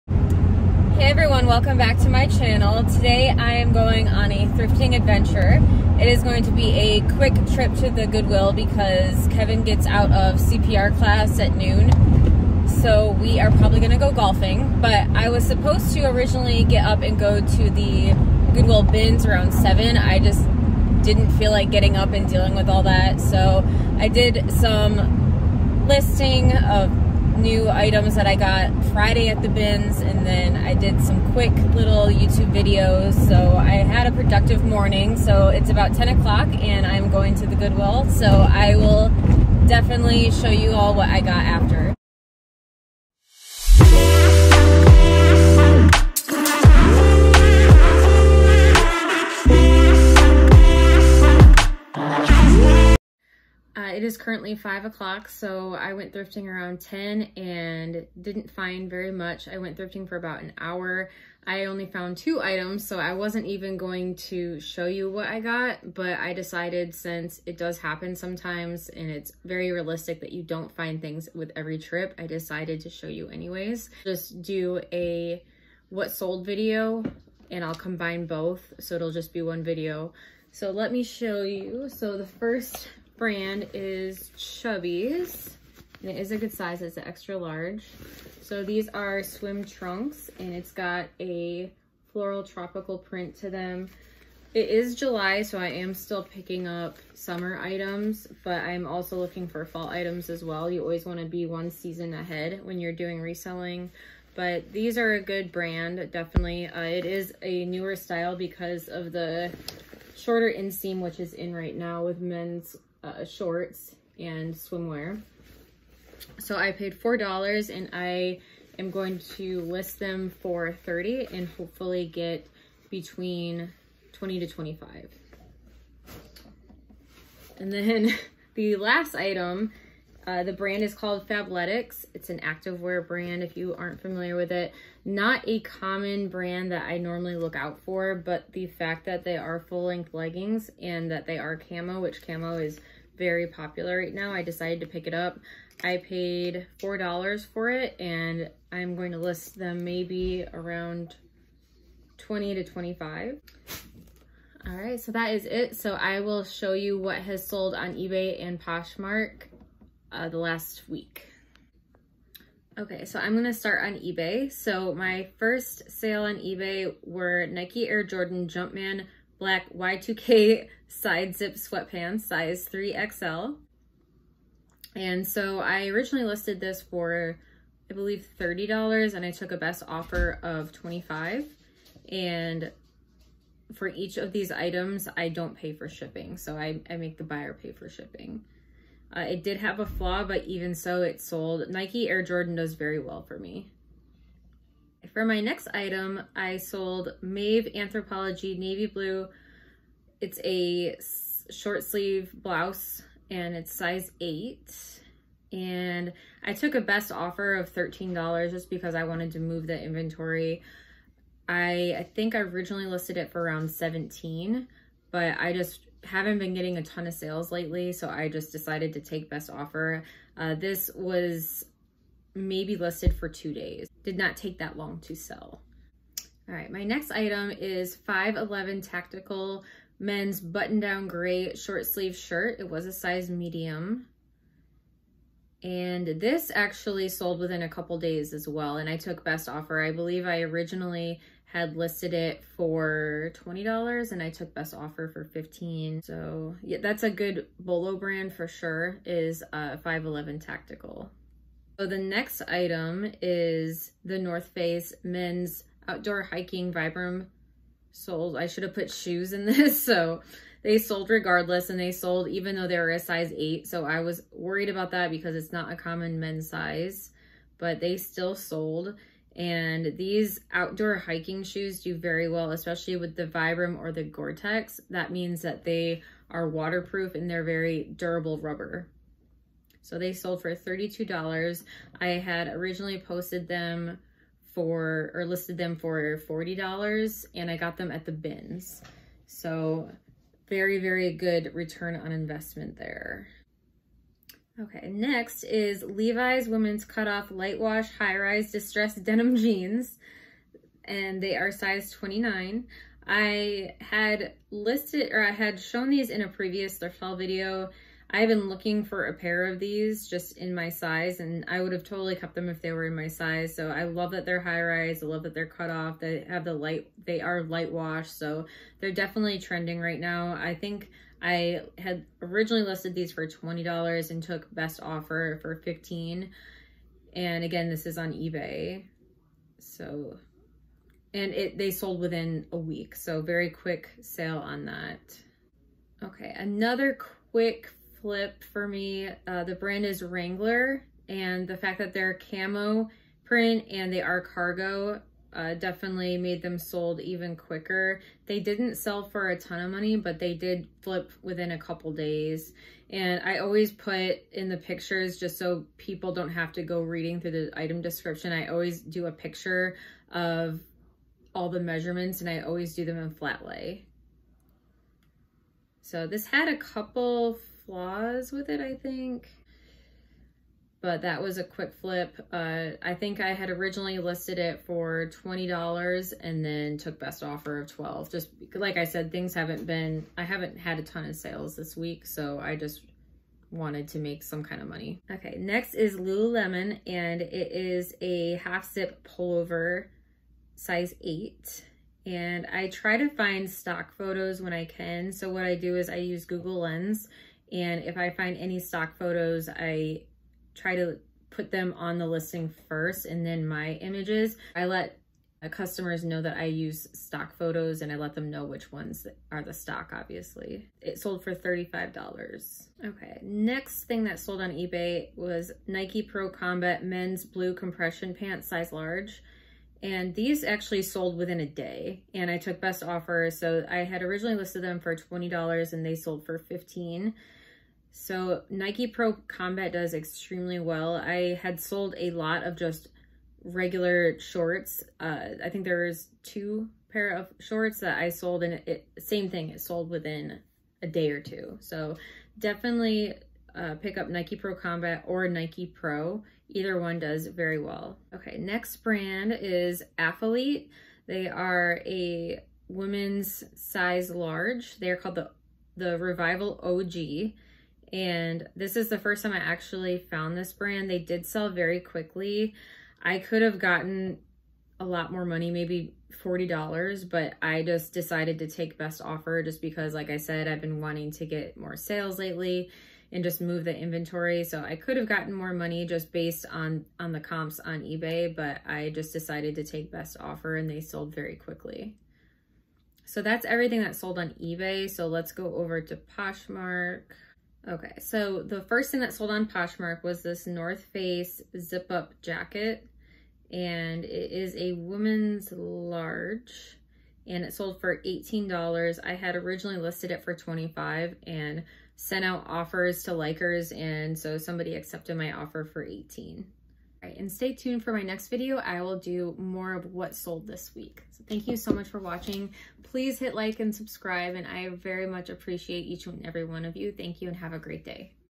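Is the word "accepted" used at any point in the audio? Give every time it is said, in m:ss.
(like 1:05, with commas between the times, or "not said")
8:24.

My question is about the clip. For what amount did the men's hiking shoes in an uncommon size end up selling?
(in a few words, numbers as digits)
$32.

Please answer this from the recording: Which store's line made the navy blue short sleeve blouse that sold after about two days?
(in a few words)
Anthropologie.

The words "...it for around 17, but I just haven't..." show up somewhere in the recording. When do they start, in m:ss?
3:33.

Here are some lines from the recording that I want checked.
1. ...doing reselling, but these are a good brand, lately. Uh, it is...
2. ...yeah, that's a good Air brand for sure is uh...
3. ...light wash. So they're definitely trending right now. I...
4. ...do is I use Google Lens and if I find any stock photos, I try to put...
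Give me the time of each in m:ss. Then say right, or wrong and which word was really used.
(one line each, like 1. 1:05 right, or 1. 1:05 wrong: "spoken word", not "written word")
1. 1:42 wrong: "definitely", not "lately"
2. 4:06 wrong: "Bolo", not "Air"
3. 5:17 right
4. 6:35 right.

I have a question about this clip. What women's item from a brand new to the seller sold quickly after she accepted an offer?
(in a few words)
Revival OG.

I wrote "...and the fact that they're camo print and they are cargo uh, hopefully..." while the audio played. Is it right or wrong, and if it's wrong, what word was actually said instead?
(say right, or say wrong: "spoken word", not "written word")
wrong: "definitely", not "hopefully".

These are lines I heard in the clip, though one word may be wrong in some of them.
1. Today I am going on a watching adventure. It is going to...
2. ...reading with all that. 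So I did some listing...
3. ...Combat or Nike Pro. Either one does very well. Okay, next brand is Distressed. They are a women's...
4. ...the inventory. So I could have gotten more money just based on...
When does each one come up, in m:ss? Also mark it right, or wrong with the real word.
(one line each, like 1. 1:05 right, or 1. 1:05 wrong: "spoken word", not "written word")
1. 0:02 wrong: "thrifting", not "watching"
2. 0:22 wrong: "dealing", not "reading"
3. 7:24 wrong: "Athleta", not "Distressed"
4. 7:53 right.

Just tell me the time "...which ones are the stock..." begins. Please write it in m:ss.
6:48.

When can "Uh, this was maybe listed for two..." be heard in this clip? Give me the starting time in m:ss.
3:40.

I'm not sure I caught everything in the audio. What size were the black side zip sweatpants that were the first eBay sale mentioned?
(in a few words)
3XL.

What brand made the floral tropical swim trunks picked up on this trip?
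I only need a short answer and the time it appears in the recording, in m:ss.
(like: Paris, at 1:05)
Chubbies, at 1:24.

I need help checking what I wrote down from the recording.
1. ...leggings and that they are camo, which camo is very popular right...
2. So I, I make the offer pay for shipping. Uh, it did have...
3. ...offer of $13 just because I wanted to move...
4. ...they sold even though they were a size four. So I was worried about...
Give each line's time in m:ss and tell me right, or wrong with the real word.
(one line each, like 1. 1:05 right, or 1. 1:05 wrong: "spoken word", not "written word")
1. 2:20 right
2. 3:06 wrong: "buyer", not "offer"
3. 3:27 right
4. 4:21 wrong: "eight", not "four".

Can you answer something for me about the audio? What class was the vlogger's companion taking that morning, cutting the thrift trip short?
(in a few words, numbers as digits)
CPR.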